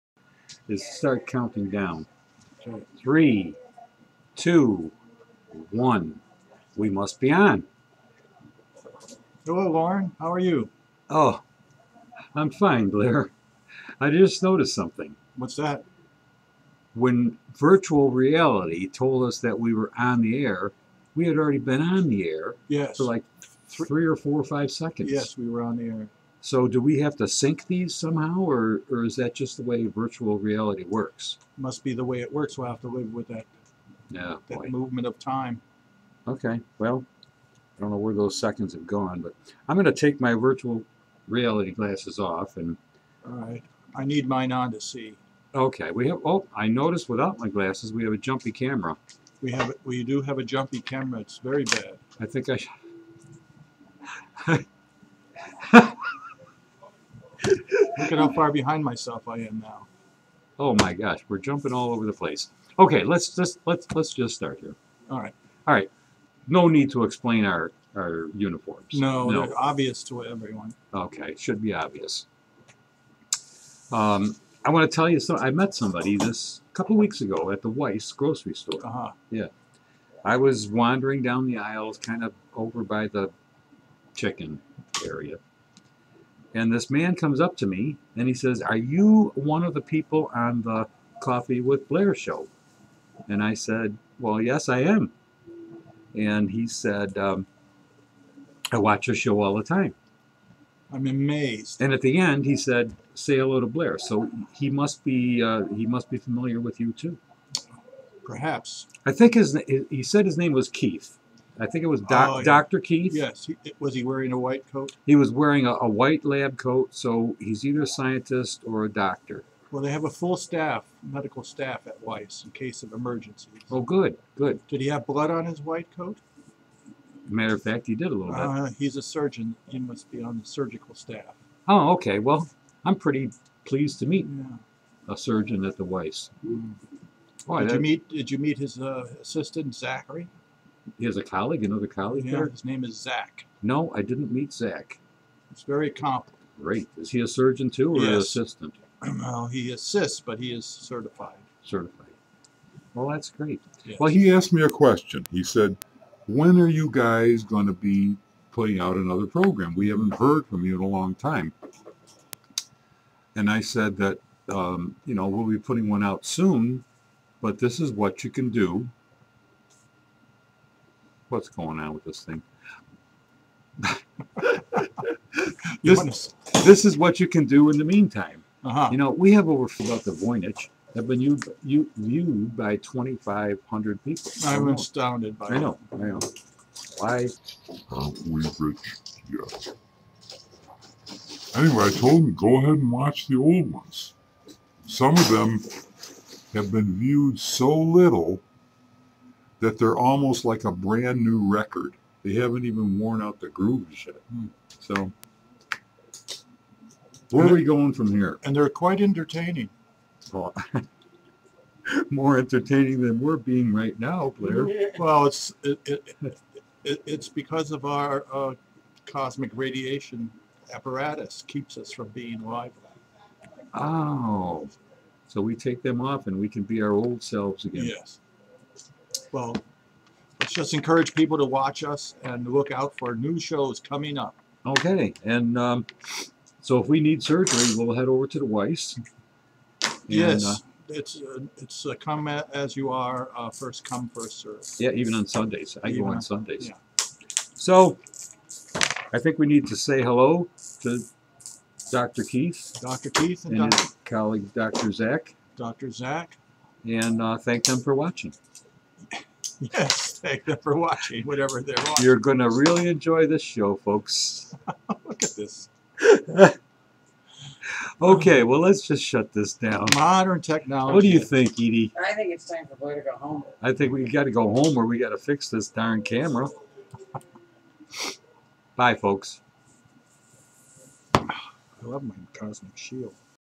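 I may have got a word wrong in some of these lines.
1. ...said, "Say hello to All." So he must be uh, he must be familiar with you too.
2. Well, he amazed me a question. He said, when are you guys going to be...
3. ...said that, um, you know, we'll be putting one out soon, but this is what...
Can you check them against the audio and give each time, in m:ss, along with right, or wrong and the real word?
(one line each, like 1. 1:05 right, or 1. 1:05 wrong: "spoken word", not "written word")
1. 1:42 wrong: "Blair", not "All"
2. 2:33 wrong: "asked", not "amazed"
3. 2:43 right.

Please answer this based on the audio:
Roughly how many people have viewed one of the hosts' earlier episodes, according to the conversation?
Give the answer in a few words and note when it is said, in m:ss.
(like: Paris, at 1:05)
2,500, at 3:02.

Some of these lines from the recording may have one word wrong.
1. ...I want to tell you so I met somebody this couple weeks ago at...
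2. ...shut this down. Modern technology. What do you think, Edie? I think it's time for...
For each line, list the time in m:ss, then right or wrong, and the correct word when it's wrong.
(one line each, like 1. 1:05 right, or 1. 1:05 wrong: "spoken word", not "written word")
1. 1:14 right
2. 4:29 right.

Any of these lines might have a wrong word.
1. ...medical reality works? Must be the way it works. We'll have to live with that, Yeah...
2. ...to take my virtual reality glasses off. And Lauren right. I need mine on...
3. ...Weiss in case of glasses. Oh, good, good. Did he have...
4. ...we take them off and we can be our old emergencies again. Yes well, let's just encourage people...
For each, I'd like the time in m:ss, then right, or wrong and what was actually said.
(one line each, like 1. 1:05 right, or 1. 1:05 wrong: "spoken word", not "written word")
1. 0:29 wrong: "virtual", not "medical"
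2. 0:39 wrong: "All", not "Lauren"
3. 2:02 wrong: "emergencies", not "glasses"
4. 3:45 wrong: "selves", not "emergencies".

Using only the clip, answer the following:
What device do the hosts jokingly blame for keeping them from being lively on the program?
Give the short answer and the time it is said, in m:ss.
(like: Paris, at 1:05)
cosmic radiation apparatus, at 3:39.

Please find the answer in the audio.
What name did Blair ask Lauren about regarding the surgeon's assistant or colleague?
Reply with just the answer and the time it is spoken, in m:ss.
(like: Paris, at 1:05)
Zachary, at 2:19.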